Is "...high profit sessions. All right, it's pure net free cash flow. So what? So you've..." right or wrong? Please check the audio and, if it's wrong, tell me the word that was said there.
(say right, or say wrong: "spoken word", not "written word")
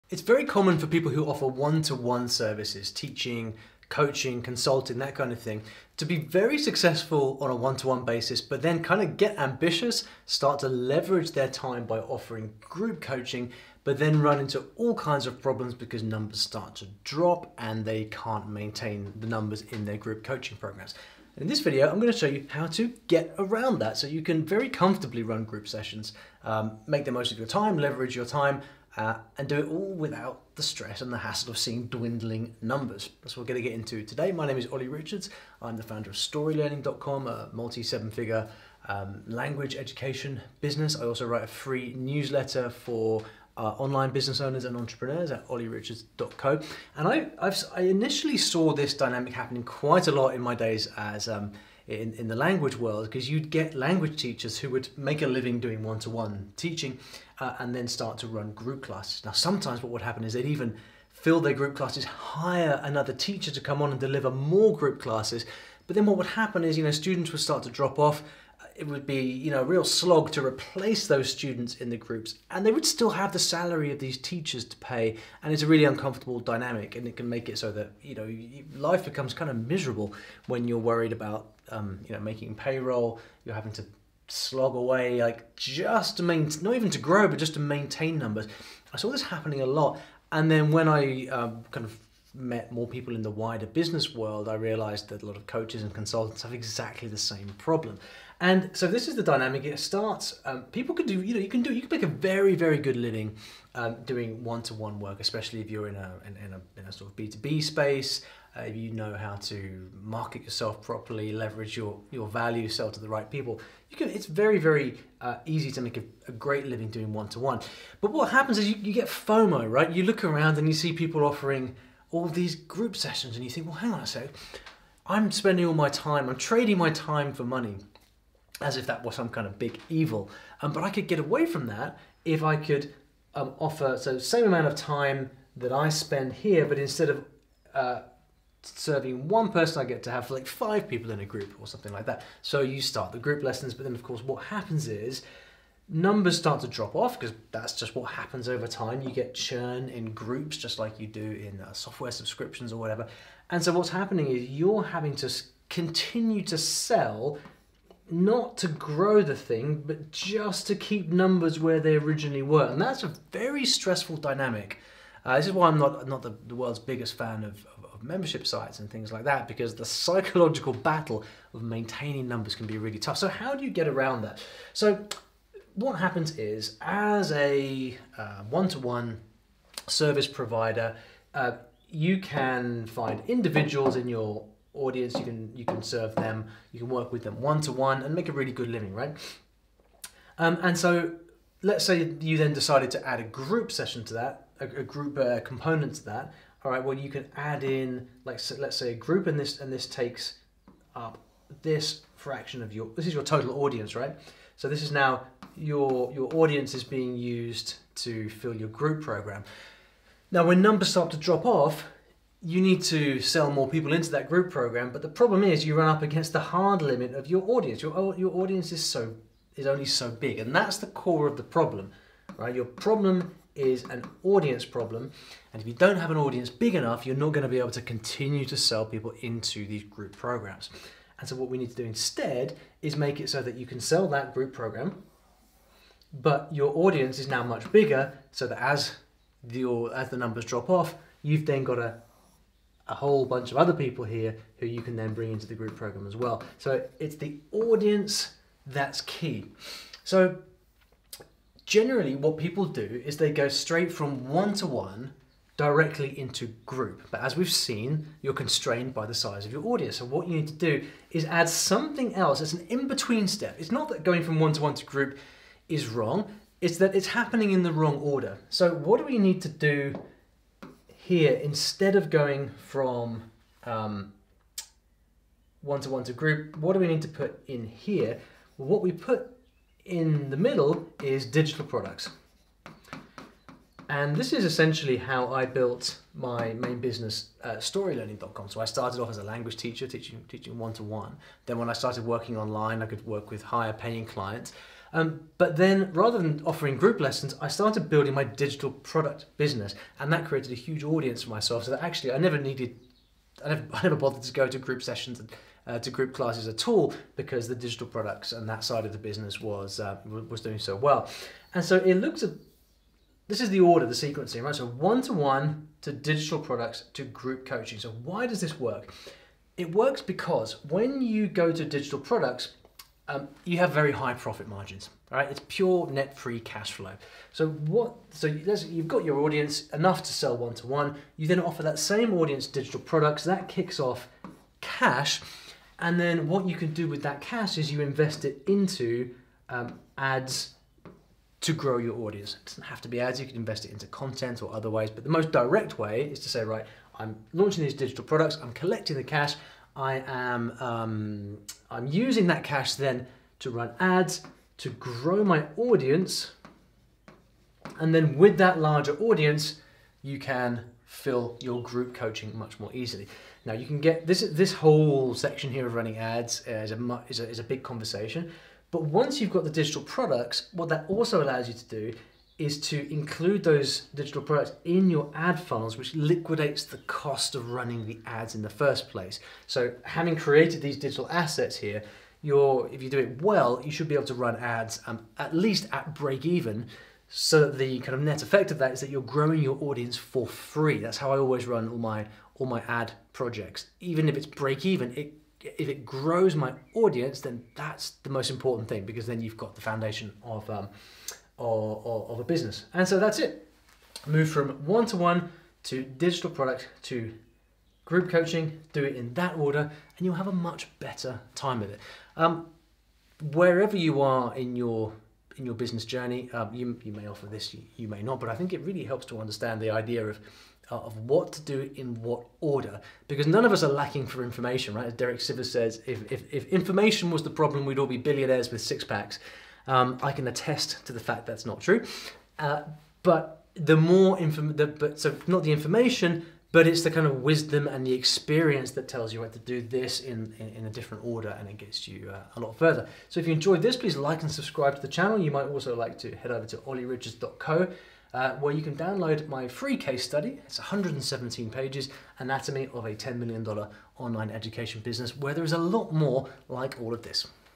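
wrong: "margins", not "sessions".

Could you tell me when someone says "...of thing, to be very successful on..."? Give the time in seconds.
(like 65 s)
5 s.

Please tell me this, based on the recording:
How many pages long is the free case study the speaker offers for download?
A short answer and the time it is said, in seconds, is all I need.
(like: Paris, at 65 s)
117, at 450 s.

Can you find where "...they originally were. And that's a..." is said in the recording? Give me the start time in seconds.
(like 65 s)
161 s.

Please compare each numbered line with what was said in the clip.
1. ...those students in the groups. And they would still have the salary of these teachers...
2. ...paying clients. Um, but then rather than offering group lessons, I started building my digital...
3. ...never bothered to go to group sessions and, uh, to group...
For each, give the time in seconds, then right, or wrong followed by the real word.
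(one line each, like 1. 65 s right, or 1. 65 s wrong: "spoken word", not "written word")
1. 71 s right
2. 293 s right
3. 303 s right.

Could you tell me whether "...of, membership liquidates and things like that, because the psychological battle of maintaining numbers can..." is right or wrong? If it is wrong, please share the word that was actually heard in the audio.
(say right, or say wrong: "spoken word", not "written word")
wrong: "sites", not "liquidates".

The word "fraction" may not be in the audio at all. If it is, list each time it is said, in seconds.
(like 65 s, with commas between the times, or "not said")
202 s.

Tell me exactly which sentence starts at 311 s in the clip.
And so it looks at, this is the order, the sequencing, right?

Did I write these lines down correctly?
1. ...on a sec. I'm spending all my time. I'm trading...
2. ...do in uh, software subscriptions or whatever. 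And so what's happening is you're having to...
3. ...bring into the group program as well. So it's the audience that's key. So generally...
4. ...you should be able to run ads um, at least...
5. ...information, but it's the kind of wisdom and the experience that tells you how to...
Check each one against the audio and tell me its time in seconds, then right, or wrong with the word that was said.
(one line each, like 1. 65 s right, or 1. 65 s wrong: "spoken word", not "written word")
1. 123 s right
2. 151 s right
3. 245 s right
4. 383 s right
5. 435 s right.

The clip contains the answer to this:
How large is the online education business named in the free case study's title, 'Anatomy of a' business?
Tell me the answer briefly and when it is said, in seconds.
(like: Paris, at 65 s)
$10 million, at 452 s.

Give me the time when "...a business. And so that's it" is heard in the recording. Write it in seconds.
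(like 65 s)
402 s.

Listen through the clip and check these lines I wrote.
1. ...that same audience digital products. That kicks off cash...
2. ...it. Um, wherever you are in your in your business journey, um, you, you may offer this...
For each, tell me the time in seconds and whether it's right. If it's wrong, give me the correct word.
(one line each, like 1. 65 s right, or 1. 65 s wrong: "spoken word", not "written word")
1. 331 s right
2. 411 s right.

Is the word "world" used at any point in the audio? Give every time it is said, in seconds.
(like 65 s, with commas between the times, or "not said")
52 s, 94 s, 166 s.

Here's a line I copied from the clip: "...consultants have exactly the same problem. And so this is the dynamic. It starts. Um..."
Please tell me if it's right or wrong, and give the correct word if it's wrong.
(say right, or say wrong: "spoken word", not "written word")
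right.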